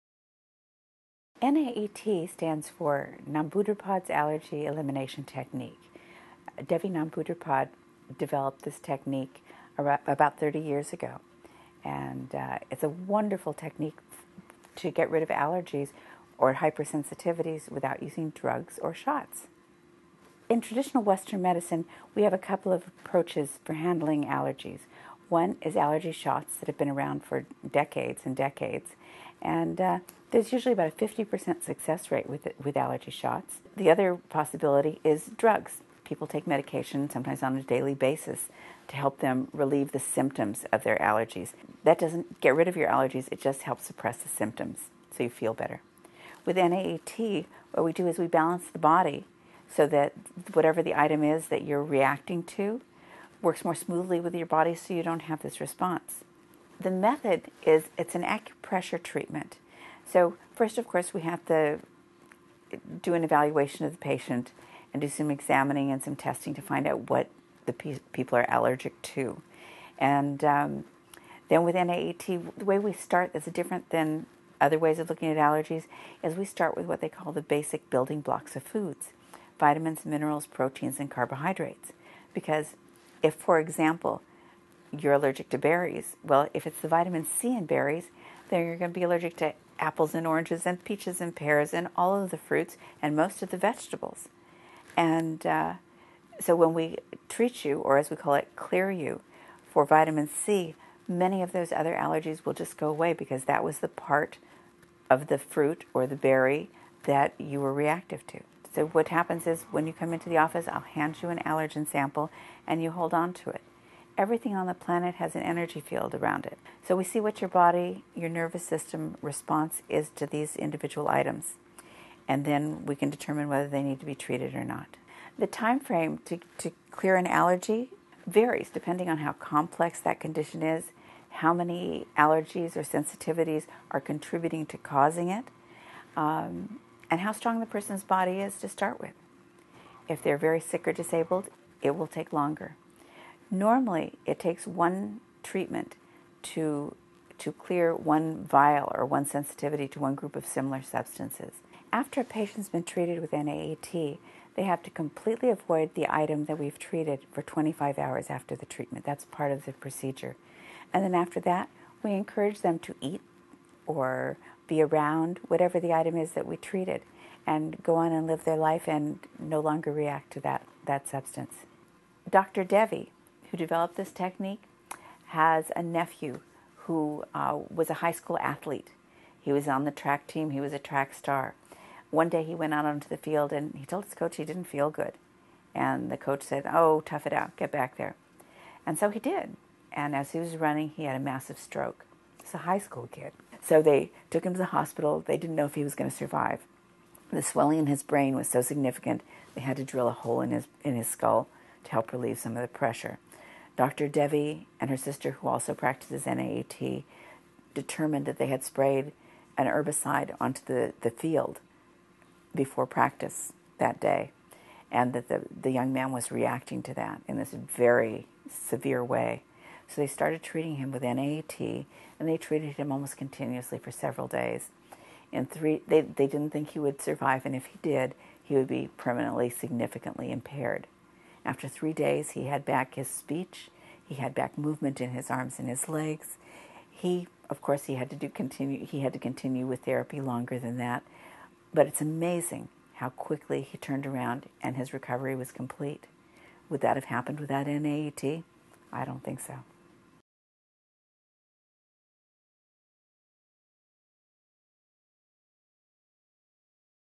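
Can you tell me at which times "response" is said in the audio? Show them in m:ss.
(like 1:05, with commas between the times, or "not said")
0:55, 1:59.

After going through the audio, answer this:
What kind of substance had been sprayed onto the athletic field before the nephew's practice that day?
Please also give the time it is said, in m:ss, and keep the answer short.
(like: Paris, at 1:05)
herbicide, at 3:29.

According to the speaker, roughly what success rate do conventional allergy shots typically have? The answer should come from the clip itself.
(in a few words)
50%.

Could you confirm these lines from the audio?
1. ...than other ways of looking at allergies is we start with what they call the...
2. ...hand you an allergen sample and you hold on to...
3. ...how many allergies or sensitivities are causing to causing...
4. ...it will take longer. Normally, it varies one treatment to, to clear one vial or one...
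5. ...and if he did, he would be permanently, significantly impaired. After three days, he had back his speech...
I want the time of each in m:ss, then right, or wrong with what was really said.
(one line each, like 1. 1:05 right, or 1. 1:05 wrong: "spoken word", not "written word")
1. 1:13 right
2. 1:50 right
3. 2:11 wrong: "contributing", not "causing"
4. 2:21 wrong: "takes", not "varies"
5. 3:47 right.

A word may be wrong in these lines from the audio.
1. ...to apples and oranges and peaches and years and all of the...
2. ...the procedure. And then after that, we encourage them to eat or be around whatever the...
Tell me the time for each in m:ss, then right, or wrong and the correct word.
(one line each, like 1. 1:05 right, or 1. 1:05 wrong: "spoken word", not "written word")
1. 1:29 wrong: "pears", not "years"
2. 2:39 right.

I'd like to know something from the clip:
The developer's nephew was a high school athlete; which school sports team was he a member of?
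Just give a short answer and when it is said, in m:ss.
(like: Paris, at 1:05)
track team, at 2:59.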